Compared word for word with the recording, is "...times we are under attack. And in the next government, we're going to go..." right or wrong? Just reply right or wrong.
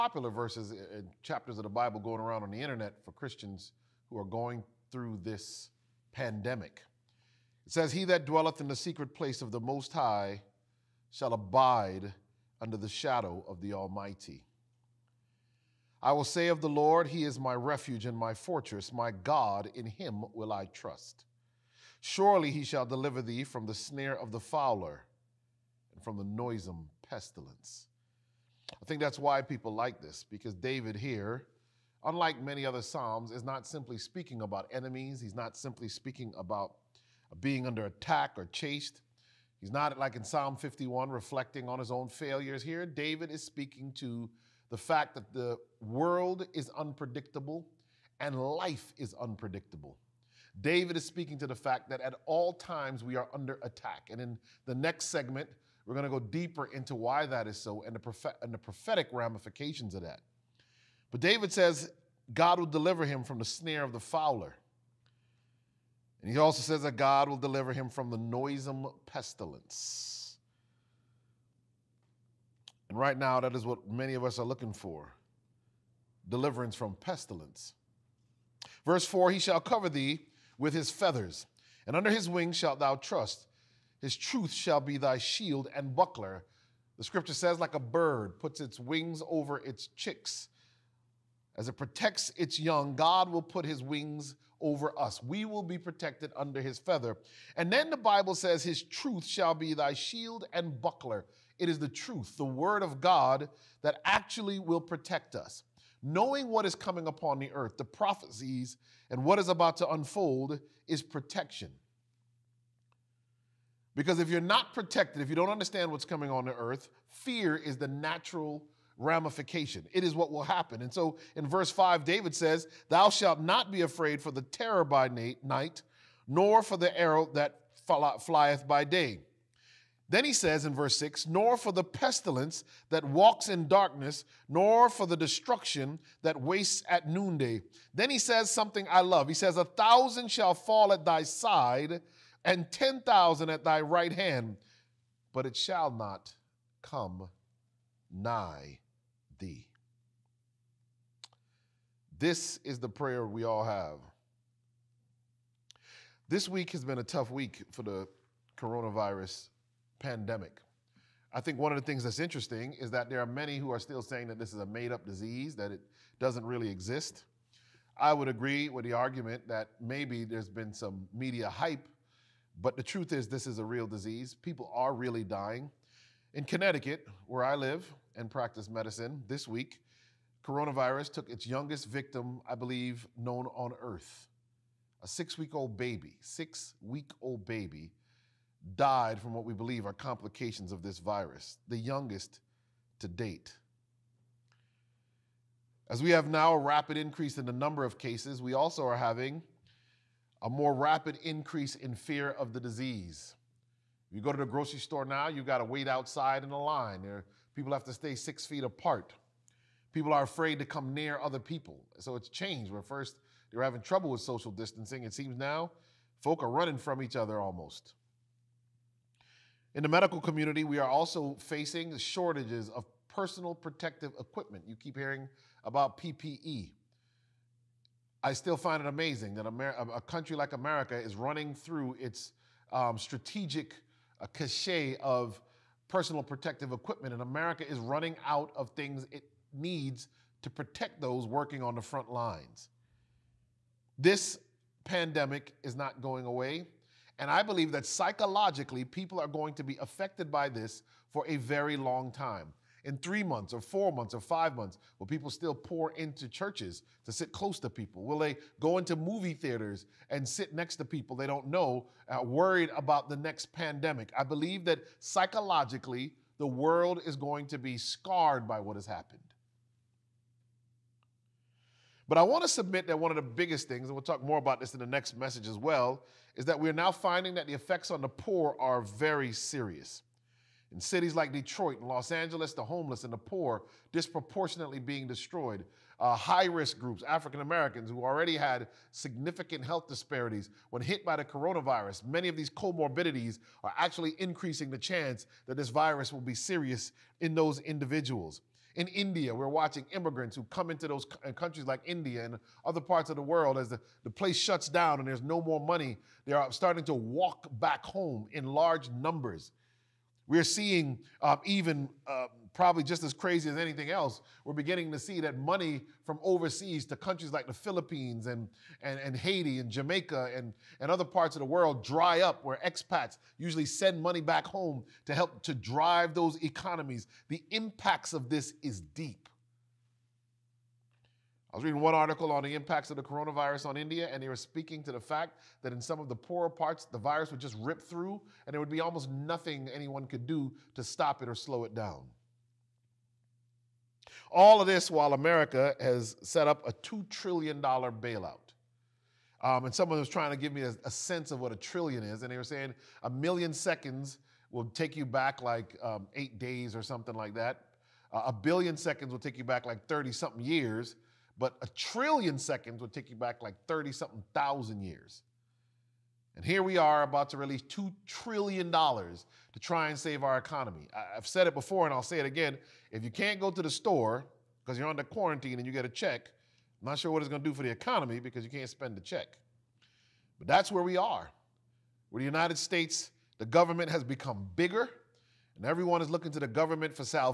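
wrong.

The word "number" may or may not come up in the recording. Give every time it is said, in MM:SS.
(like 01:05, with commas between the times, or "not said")
03:17, 05:08.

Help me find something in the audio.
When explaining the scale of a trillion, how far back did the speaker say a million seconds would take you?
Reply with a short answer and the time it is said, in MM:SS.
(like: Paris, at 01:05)
8 days, at 05:56.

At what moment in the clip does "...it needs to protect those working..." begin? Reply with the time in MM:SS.
03:59.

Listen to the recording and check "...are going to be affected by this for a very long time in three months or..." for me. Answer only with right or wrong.
right.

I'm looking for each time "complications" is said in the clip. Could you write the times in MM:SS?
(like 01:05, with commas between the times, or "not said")
03:09.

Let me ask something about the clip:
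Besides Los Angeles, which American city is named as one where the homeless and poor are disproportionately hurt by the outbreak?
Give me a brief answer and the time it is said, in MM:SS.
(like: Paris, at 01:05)
Detroit, at 04:41.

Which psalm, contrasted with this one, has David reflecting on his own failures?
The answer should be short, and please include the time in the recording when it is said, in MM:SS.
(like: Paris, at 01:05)
Psalm 51, at 00:40.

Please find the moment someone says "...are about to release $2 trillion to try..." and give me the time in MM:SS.
06:06.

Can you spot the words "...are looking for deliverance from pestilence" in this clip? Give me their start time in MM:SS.
01:14.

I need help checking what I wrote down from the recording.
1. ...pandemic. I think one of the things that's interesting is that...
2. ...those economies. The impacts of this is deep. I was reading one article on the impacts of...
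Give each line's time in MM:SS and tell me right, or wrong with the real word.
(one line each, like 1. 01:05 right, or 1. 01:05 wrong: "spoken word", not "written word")
1. 02:39 right
2. 05:26 right.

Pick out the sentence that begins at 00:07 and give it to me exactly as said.
It says, He that dwelleth in the secret place of the Most High shall abide under the shadow of the Almighty.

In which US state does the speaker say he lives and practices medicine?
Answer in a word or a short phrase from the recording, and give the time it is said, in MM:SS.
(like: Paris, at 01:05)
Connecticut, at 02:56.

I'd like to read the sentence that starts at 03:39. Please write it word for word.
In the medical community, we are also facing shortages of personal protective equipment.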